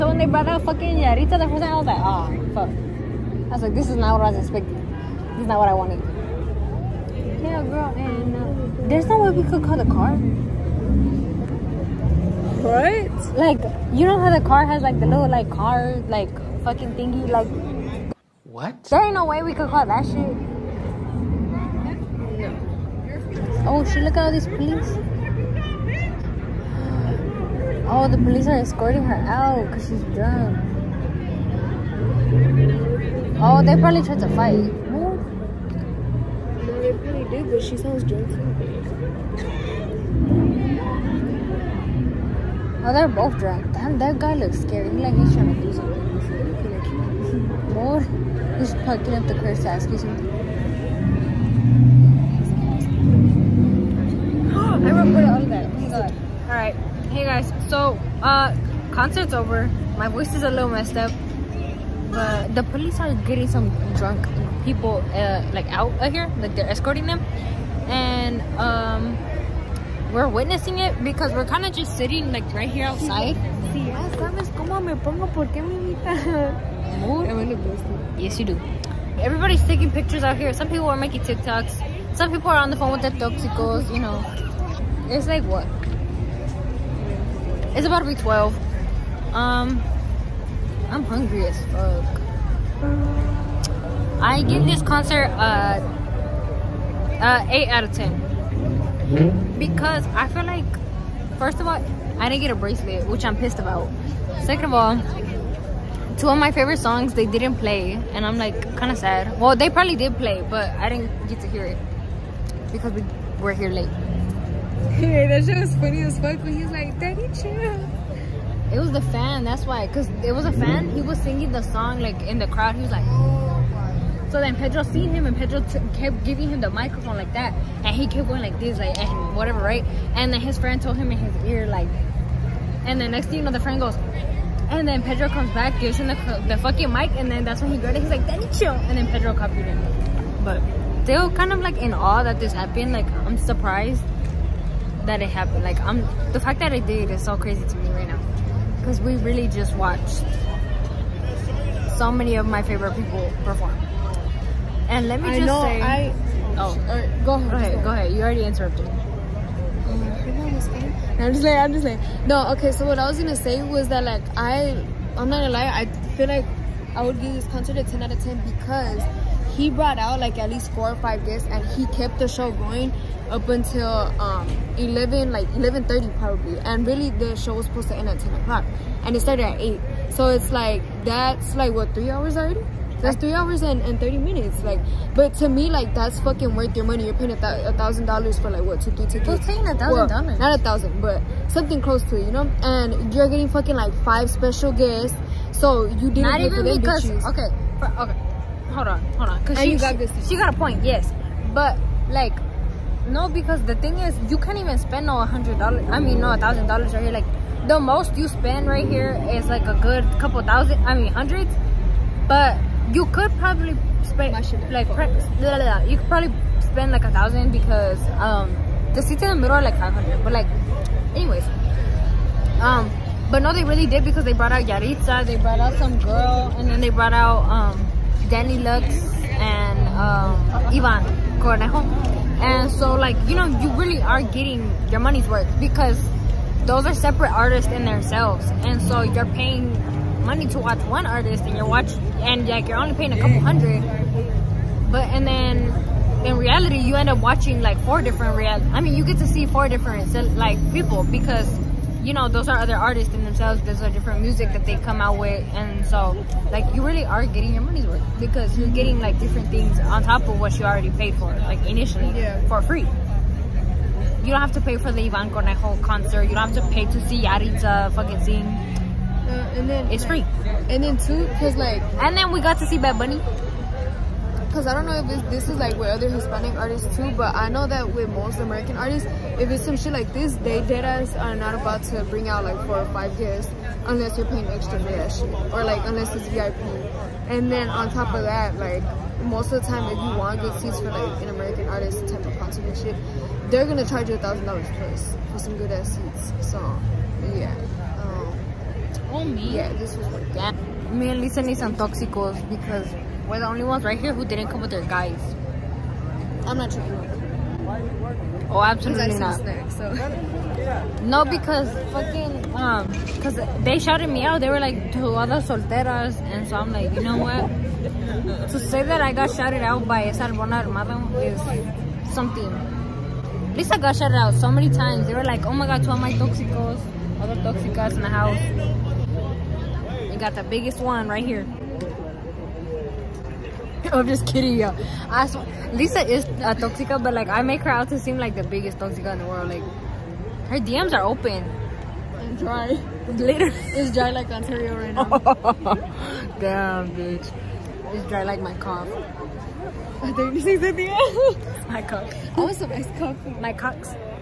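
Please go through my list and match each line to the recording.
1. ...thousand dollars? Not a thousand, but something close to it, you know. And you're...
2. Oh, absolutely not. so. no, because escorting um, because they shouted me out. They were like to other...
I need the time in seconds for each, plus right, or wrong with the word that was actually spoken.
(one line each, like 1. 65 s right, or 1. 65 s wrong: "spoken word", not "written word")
1. 189 s right
2. 308 s wrong: "fucking", not "escorting".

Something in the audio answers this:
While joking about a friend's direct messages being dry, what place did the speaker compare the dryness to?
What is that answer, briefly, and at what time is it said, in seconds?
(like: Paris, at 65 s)
Ontario, at 344 s.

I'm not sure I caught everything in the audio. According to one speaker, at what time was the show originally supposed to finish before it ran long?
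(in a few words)
10 o'clock.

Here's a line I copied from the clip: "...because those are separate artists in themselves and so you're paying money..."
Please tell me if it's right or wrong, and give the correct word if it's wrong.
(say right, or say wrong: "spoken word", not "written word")
right.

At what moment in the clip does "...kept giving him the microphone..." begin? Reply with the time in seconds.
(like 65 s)
125 s.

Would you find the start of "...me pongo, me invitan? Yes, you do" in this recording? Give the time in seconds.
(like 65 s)
74 s.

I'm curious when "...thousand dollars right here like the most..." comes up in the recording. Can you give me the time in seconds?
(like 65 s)
206 s.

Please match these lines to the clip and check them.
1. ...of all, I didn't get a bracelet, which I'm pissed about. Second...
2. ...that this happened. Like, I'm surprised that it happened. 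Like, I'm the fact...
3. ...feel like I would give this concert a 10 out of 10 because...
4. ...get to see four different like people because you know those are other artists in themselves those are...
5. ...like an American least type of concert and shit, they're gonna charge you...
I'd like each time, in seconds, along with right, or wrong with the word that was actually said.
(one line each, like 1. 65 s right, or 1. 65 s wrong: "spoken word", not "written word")
1. 101 s right
2. 142 s right
3. 166 s right
4. 249 s right
5. 290 s wrong: "artist", not "least".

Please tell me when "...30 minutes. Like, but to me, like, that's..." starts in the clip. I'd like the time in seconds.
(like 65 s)
183 s.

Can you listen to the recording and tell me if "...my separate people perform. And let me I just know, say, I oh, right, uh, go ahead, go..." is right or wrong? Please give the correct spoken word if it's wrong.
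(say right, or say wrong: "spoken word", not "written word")
wrong: "favorite", not "separate".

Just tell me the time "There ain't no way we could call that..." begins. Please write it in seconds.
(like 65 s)
18 s.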